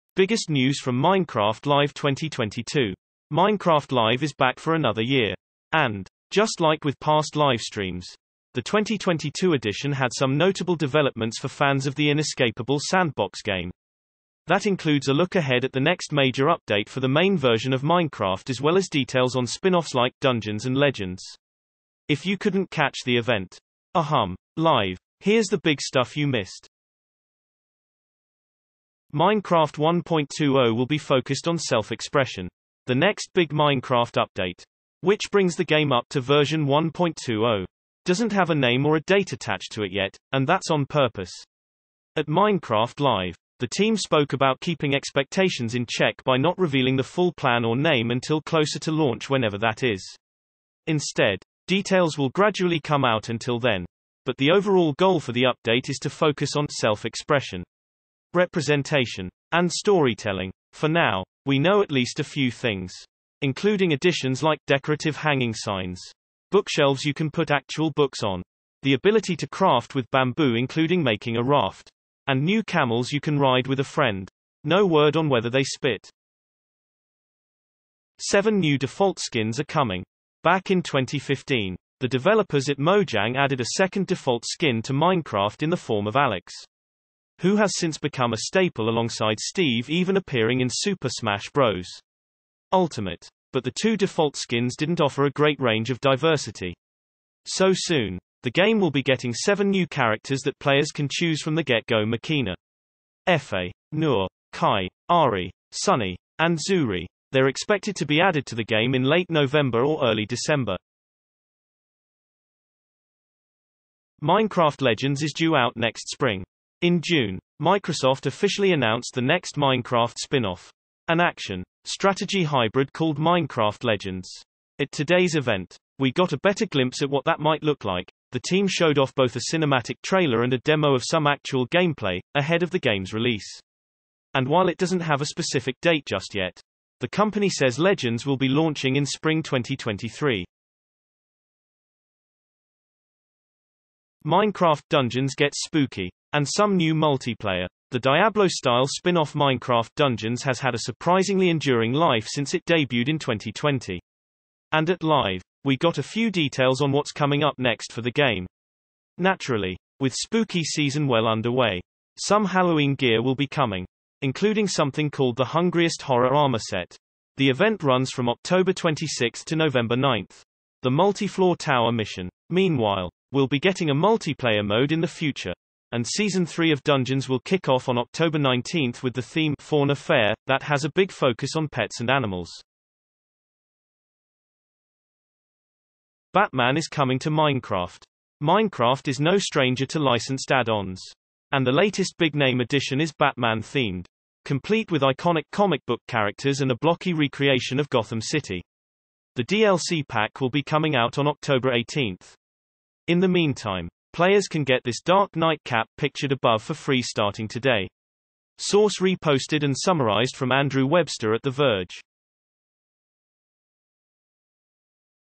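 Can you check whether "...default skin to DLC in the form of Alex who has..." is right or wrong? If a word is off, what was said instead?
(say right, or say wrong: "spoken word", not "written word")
wrong: "Minecraft", not "DLC".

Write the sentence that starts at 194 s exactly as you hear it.
Complete with iconic comic book characters and a blocky recreation of Gotham City.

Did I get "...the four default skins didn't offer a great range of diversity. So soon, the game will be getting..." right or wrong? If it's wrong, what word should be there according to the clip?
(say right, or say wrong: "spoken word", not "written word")
wrong: "two", not "four".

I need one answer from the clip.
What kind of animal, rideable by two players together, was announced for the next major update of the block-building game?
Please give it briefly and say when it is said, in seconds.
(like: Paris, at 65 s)
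Camels, at 72 s.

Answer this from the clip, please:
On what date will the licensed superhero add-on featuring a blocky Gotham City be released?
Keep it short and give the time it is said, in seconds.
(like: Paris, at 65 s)
October 18, at 201 s.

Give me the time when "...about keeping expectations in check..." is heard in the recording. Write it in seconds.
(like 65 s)
44 s.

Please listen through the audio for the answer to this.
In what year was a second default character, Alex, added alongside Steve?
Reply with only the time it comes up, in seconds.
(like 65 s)
80 s.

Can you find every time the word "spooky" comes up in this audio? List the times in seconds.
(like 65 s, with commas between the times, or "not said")
145 s, 160 s.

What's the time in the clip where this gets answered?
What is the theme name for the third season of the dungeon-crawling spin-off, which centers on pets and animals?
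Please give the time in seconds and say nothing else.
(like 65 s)
179 s.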